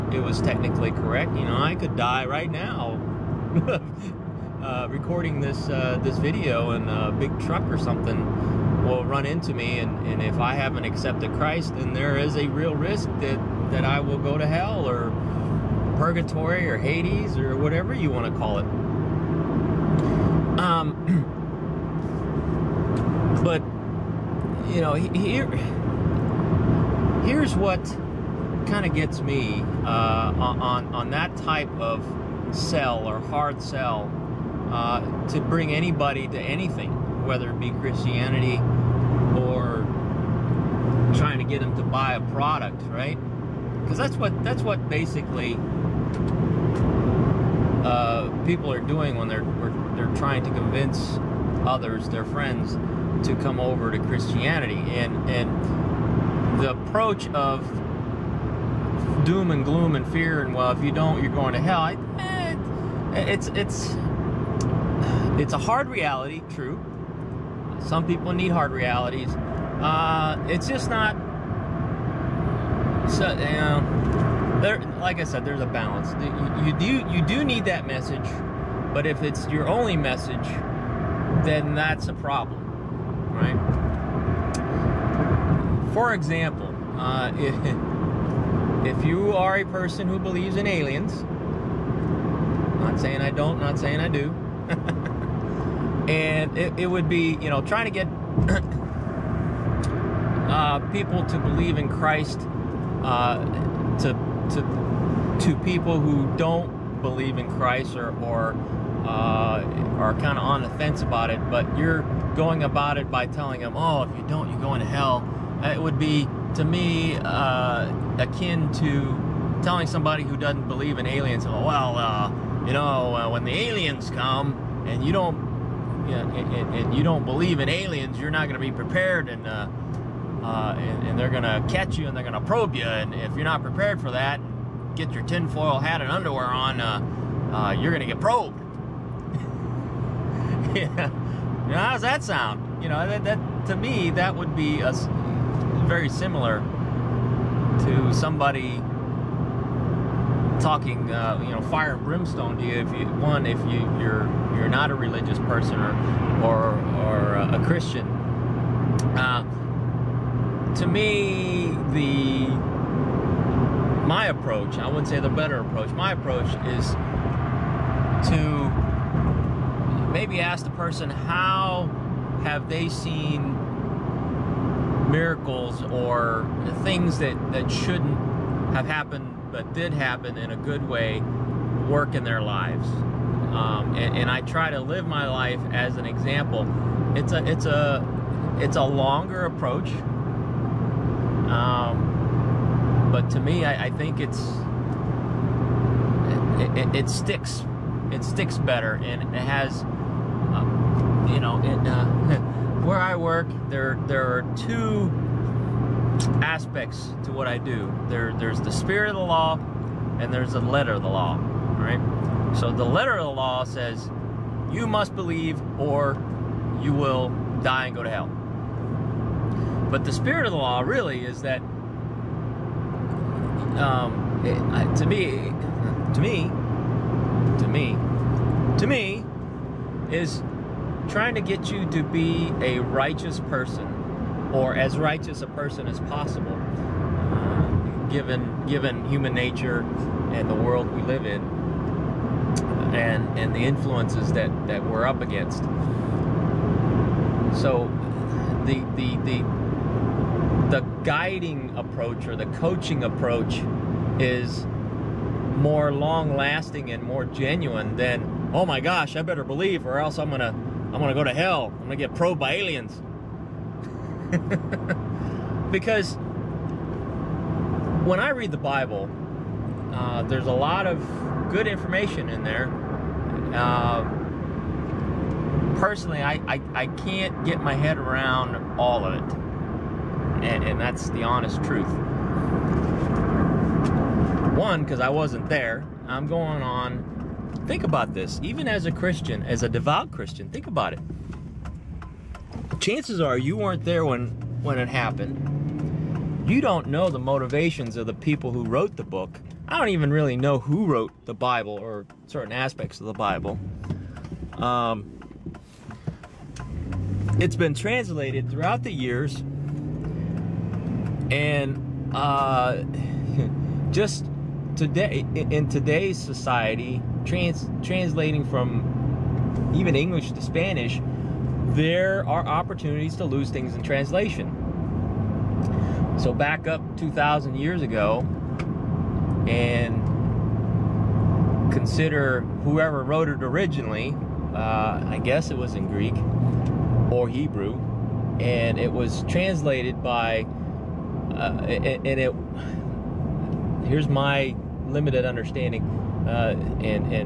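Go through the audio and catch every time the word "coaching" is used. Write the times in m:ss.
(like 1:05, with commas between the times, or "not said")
4:12.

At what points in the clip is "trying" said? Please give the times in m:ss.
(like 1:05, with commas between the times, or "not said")
0:41, 0:50, 1:37, 3:51.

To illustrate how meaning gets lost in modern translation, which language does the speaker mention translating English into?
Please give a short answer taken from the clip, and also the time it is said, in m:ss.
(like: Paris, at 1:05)
Spanish, at 5:20.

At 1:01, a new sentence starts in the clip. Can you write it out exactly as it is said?
I, eh, it's it's it's a hard reality, true.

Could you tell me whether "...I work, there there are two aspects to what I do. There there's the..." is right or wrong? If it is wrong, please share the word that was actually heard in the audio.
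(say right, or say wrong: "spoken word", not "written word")
right.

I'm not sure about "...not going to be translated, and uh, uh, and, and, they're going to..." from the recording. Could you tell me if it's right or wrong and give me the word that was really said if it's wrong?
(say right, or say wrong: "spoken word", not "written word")
wrong: "prepared", not "translated".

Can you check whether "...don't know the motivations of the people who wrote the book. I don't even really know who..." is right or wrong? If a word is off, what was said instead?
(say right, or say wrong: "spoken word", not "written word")
right.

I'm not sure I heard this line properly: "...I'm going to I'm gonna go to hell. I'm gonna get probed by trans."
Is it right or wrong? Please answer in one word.
wrong.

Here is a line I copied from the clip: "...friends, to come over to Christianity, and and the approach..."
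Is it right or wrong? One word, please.
right.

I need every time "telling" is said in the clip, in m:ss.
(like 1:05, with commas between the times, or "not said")
1:53, 1:59.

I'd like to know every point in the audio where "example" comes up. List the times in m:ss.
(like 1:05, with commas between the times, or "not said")
1:26, 3:06.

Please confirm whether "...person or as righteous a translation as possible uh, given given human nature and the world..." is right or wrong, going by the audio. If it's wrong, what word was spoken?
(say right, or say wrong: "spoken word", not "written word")
wrong: "person", not "translation".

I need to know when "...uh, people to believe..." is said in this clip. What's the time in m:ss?
1:40.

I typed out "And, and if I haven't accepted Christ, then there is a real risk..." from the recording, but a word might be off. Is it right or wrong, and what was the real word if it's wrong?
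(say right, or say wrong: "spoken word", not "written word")
right.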